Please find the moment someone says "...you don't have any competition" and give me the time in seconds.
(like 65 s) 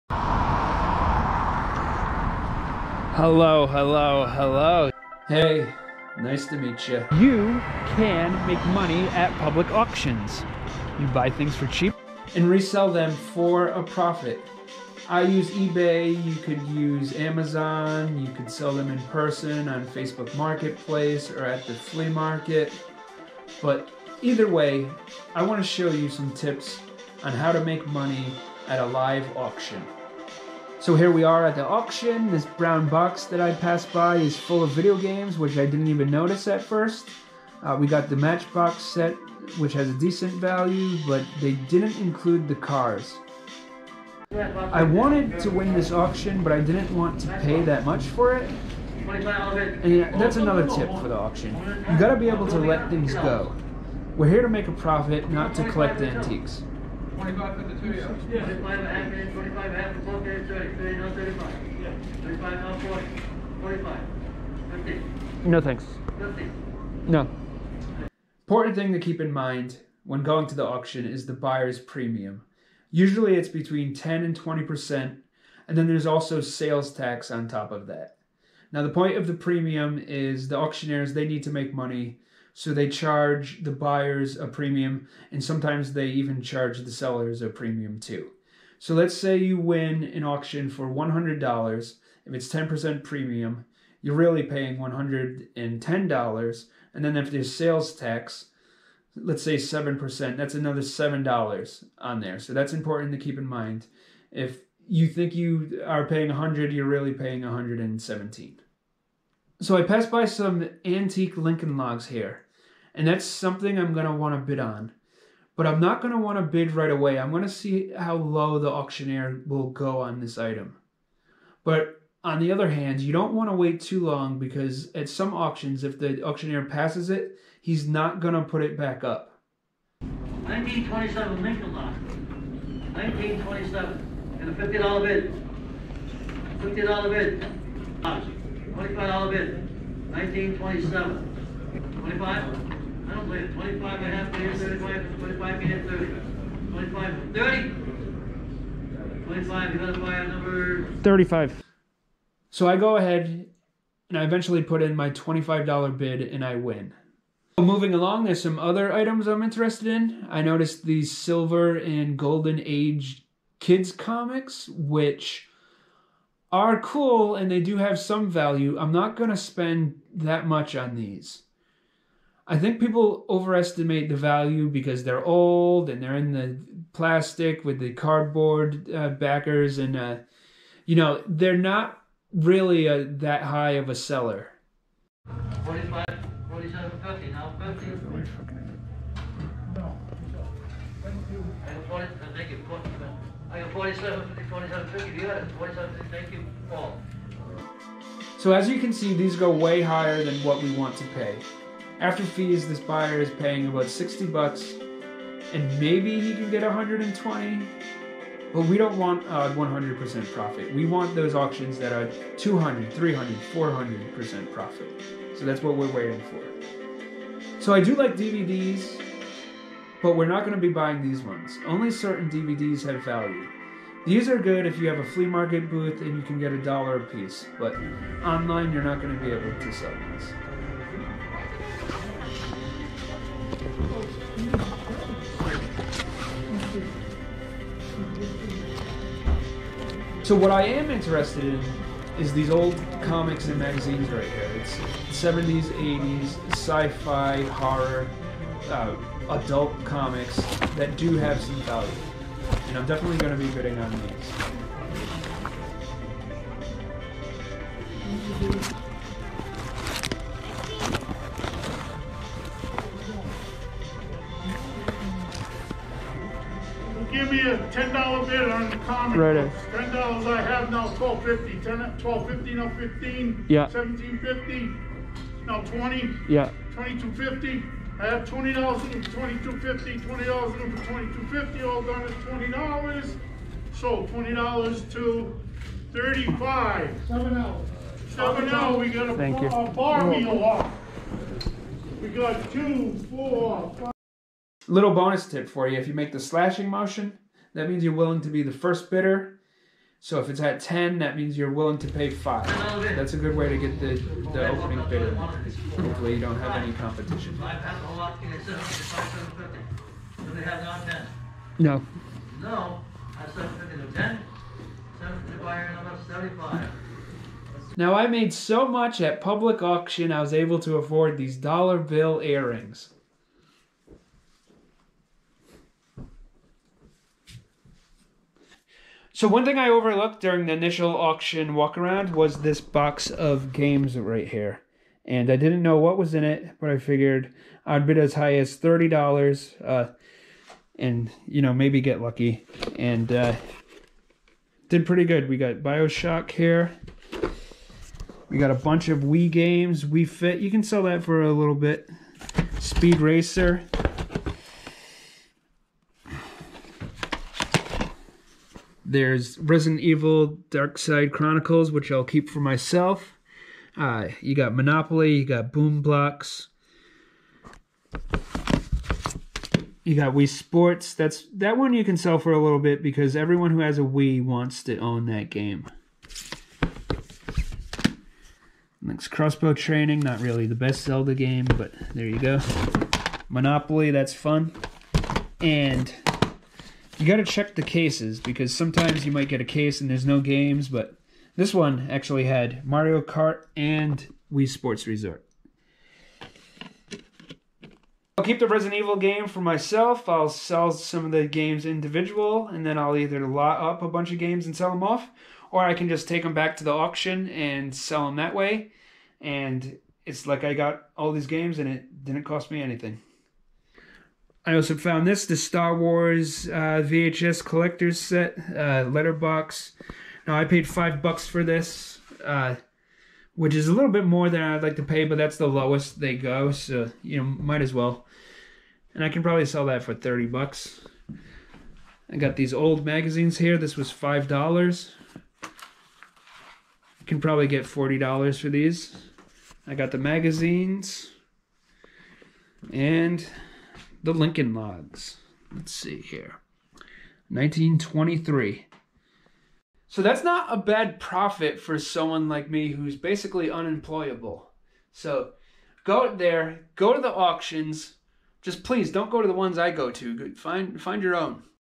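306 s.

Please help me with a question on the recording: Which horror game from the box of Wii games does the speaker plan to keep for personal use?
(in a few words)
Resident Evil Darkside Chronicles.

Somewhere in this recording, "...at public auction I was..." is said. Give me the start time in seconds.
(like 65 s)
319 s.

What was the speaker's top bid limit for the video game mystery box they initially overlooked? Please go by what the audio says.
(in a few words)
$30.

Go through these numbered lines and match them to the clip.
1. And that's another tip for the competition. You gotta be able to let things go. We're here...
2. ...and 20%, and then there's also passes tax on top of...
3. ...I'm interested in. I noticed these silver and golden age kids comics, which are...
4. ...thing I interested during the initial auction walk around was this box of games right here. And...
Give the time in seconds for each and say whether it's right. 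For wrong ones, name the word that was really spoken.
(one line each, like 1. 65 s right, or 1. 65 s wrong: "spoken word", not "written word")
1. 49 s wrong: "auction", not "competition"
2. 74 s wrong: "sales", not "passes"
3. 159 s right
4. 329 s wrong: "overlooked", not "interested".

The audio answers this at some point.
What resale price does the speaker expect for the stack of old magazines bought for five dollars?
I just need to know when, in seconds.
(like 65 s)
437 s.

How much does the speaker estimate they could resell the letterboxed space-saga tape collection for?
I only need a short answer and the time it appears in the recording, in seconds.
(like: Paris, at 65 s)
$30, at 429 s.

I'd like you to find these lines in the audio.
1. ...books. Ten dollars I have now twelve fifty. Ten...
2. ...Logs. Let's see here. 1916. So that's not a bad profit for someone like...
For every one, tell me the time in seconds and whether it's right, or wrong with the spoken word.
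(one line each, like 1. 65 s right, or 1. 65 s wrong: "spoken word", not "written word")
1. 269 s right
2. 444 s wrong: "1923", not "1916".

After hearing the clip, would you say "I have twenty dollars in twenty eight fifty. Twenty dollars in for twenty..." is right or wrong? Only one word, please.
wrong.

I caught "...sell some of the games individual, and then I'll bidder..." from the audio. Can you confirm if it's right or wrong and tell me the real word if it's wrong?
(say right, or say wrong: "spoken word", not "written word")
wrong: "either", not "bidder".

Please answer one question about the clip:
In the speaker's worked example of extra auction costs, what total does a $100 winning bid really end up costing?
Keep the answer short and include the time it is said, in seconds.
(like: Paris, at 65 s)
$117, at 107 s.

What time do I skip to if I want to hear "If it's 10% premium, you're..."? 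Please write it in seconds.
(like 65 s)
92 s.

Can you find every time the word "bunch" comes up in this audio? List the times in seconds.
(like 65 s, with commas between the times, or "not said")
348 s, 403 s.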